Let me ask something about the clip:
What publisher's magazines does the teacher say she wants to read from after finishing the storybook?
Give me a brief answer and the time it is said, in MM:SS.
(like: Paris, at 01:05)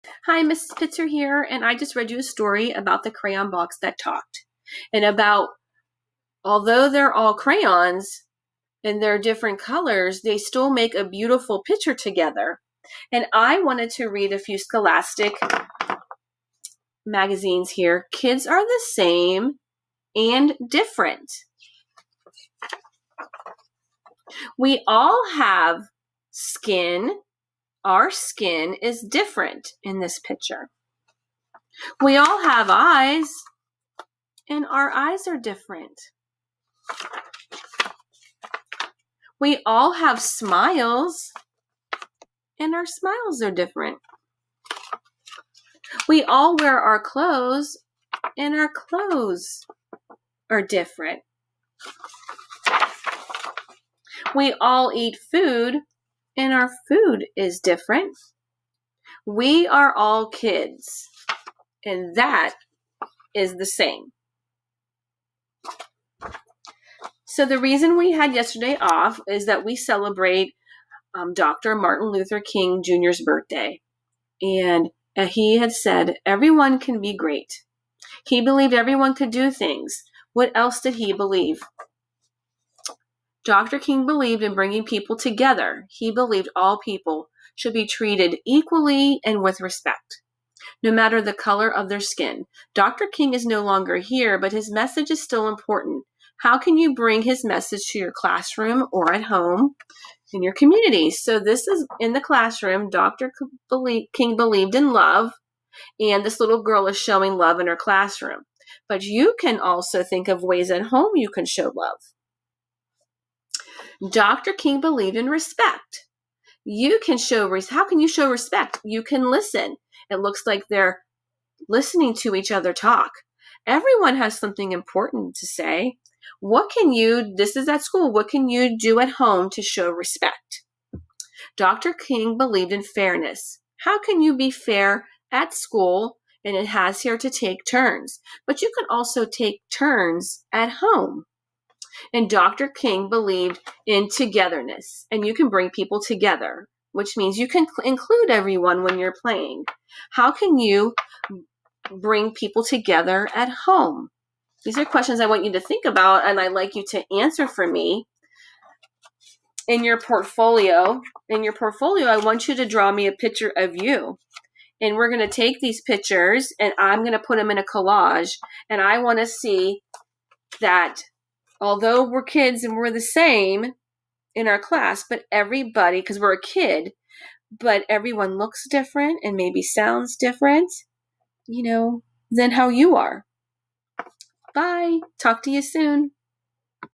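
Scholastic, at 00:14.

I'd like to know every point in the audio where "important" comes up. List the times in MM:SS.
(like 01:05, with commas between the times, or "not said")
01:35, 02:04.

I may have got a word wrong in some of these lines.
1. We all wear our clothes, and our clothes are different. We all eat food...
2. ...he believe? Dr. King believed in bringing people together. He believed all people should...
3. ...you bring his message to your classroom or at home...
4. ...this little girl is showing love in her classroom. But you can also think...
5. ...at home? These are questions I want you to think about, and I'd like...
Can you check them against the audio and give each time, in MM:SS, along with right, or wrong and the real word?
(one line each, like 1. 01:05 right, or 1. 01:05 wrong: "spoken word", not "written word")
1. 00:46 right
2. 01:20 right
3. 01:36 right
4. 01:46 right
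5. 02:33 right.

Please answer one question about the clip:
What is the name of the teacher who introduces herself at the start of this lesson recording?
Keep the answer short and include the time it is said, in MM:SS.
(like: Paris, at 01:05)
Mrs. Pitzer, at 00:00.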